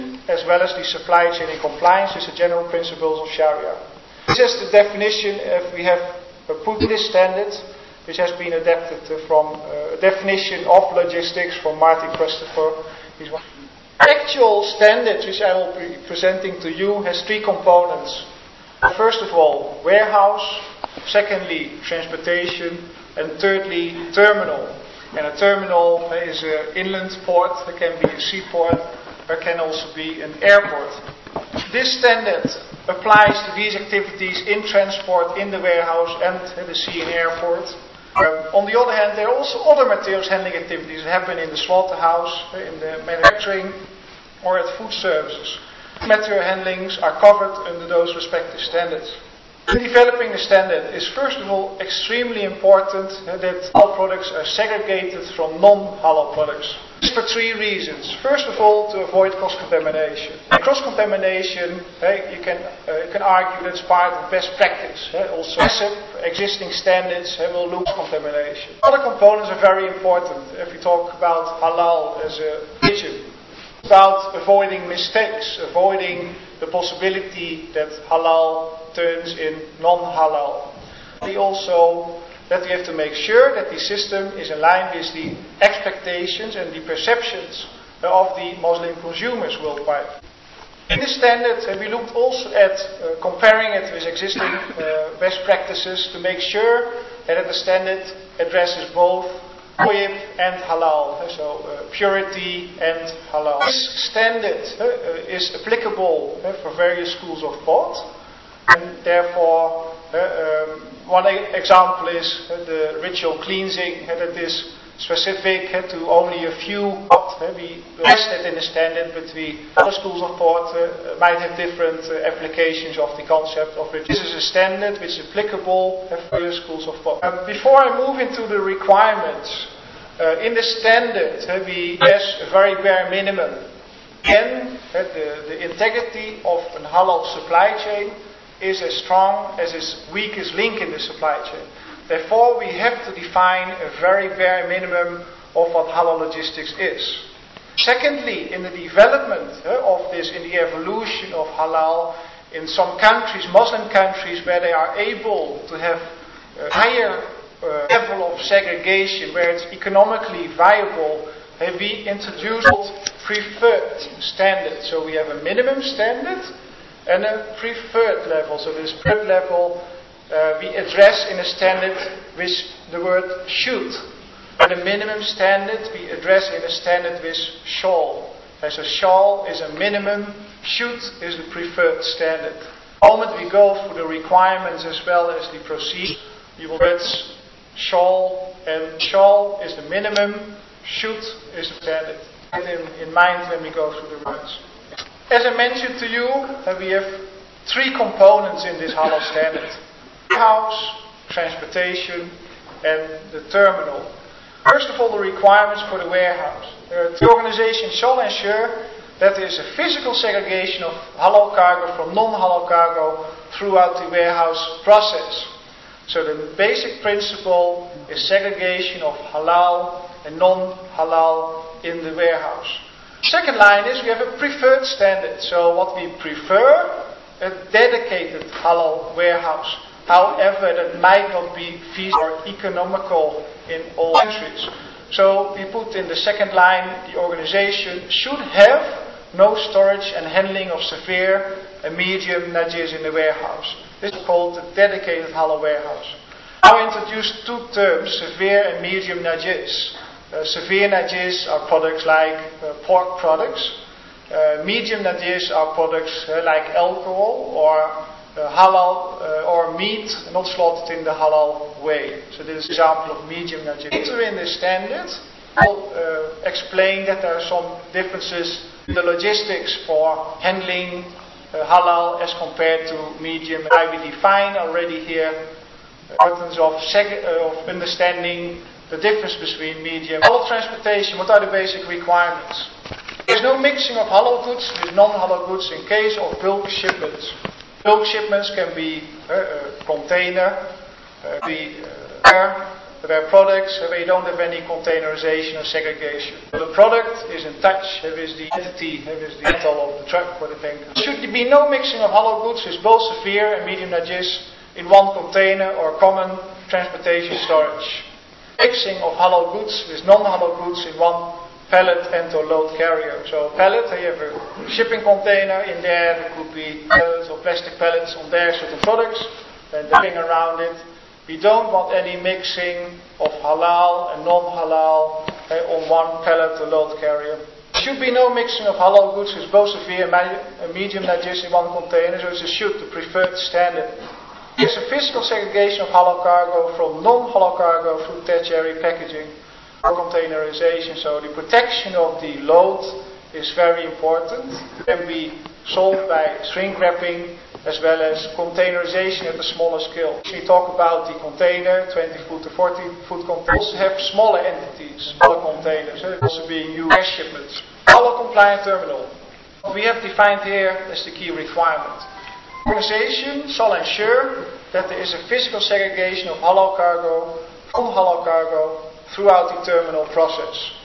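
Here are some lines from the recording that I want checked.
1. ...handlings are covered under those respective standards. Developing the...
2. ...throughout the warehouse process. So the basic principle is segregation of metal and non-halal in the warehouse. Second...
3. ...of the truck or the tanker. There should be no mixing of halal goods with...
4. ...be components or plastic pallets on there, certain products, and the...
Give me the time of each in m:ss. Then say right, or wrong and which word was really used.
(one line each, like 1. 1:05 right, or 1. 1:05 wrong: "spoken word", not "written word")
1. 0:46 right
2. 3:33 wrong: "halal", not "metal"
3. 4:59 right
4. 5:16 wrong: "pallets", not "components".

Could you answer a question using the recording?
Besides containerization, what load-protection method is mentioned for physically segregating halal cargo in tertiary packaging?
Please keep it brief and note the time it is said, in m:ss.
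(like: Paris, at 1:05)
shrink wrapping, at 5:46.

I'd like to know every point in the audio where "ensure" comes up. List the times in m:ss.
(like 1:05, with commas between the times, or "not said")
3:28, 6:03.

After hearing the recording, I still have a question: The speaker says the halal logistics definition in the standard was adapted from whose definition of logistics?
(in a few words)
Martin Christopher.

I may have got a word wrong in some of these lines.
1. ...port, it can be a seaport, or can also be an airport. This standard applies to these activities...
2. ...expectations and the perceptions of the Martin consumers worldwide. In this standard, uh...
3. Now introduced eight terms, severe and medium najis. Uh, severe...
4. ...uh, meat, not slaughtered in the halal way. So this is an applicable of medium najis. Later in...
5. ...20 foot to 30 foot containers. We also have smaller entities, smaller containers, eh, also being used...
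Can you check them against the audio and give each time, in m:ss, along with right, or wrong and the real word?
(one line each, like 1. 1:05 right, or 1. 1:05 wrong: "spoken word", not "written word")
1. 0:27 right
2. 1:25 wrong: "Muslim", not "Martin"
3. 4:06 wrong: "two", not "eight"
4. 4:19 wrong: "example", not "applicable"
5. 5:51 wrong: "40", not "30".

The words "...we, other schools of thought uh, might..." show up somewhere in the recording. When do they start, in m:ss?
1:59.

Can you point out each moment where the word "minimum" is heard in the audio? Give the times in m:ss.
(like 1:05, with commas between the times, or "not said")
2:13, 2:24, 2:45, 2:54, 2:59, 3:09.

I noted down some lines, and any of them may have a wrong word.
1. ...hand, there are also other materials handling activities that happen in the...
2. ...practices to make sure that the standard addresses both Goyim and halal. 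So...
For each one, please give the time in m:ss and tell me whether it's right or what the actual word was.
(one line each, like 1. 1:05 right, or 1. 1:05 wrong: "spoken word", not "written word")
1. 0:38 right
2. 1:35 right.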